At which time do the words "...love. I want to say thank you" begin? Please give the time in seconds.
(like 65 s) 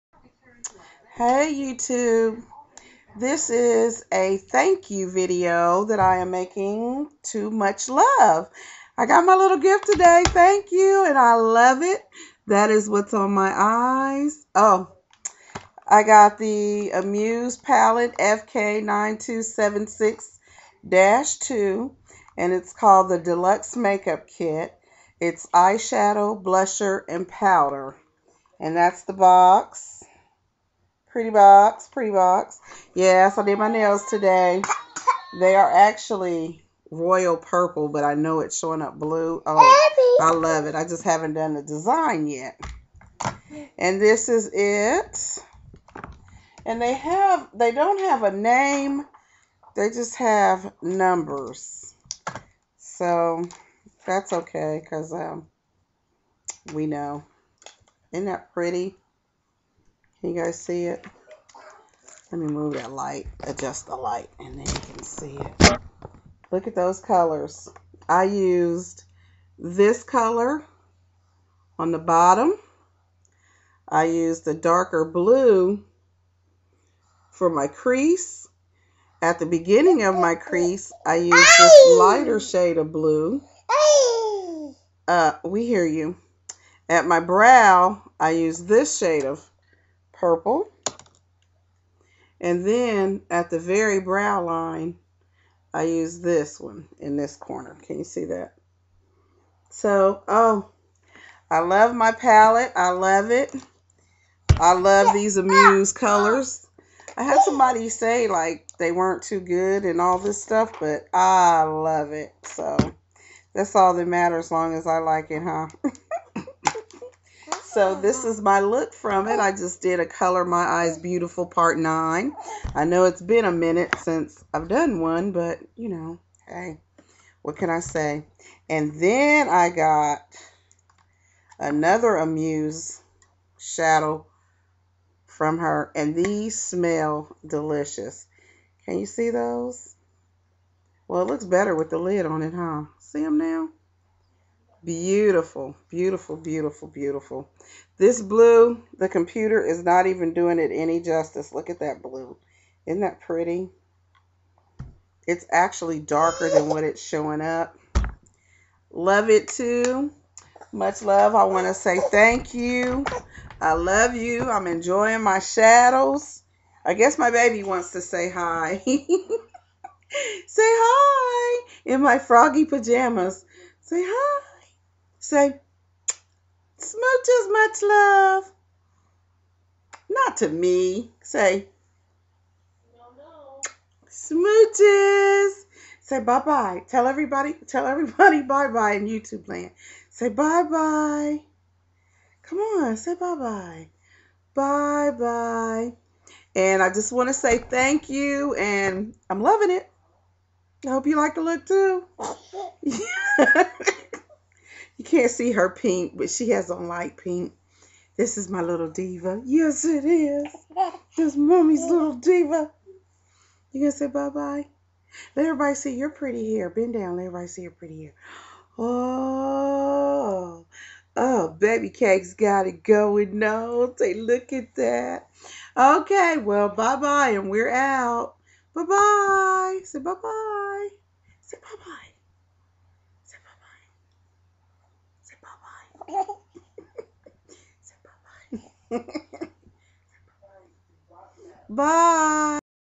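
161 s.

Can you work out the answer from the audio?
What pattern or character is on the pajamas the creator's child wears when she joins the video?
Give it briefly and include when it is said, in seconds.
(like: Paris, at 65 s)
froggy, at 172 s.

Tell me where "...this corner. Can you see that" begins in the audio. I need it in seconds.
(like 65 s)
97 s.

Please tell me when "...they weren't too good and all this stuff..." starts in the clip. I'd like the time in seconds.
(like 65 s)
108 s.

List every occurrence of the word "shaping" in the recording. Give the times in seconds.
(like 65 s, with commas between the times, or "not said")
not said.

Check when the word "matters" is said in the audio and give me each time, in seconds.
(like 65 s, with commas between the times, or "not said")
114 s.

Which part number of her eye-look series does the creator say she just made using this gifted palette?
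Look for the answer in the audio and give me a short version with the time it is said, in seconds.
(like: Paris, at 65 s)
Part 9, at 121 s.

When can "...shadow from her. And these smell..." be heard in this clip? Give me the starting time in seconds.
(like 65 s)
133 s.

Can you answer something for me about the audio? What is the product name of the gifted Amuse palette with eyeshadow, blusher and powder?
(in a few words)
Deluxe Makeup Kit.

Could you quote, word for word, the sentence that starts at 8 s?
I got my little gift today, thank you, and I love it.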